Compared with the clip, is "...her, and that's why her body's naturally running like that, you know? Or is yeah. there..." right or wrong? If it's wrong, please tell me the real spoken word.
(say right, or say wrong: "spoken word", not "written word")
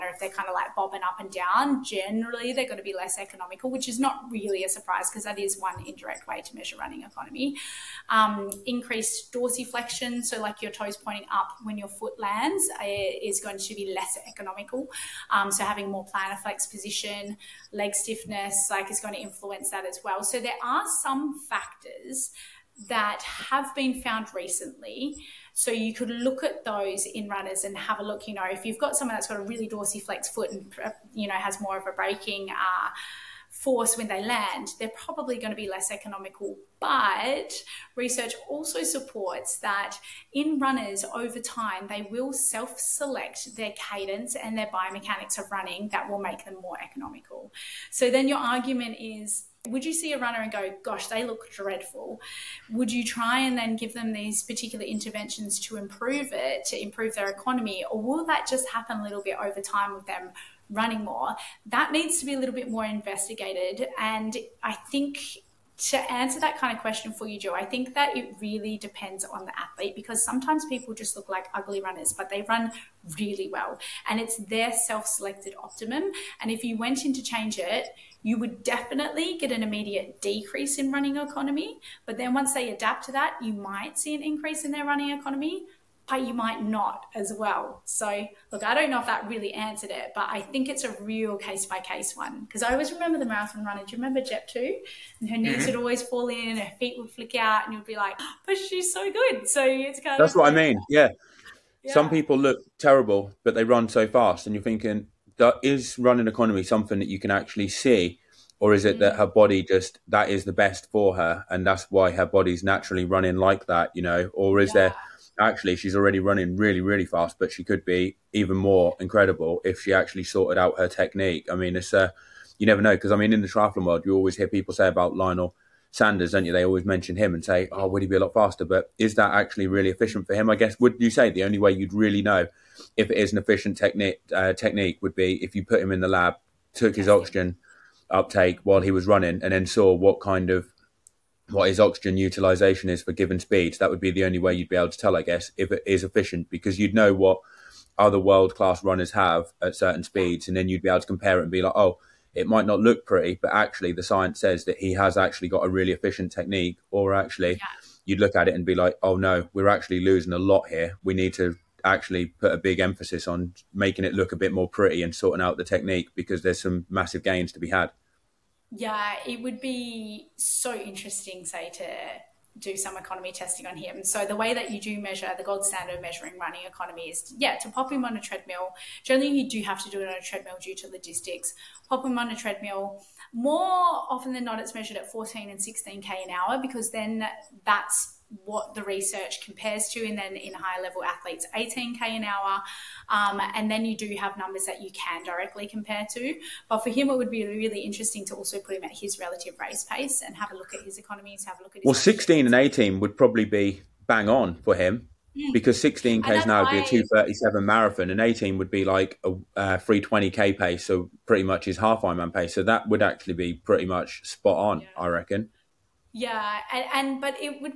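right.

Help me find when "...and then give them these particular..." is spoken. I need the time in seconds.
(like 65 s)
53 s.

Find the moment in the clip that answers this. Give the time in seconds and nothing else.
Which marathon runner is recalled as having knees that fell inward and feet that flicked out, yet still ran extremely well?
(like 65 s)
94 s.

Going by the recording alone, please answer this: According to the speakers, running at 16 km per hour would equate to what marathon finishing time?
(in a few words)
2:37.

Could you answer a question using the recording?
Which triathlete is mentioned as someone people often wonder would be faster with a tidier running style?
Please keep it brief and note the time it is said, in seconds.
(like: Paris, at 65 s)
Lionel Sanders, at 125 s.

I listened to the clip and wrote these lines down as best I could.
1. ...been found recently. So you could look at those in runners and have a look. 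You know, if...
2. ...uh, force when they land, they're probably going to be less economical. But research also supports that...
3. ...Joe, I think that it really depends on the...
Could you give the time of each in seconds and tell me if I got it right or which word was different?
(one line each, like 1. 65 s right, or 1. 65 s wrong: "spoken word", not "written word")
1. 23 s right
2. 32 s right
3. 67 s right.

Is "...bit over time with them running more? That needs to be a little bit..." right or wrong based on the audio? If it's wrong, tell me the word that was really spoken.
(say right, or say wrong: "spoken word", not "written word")
right.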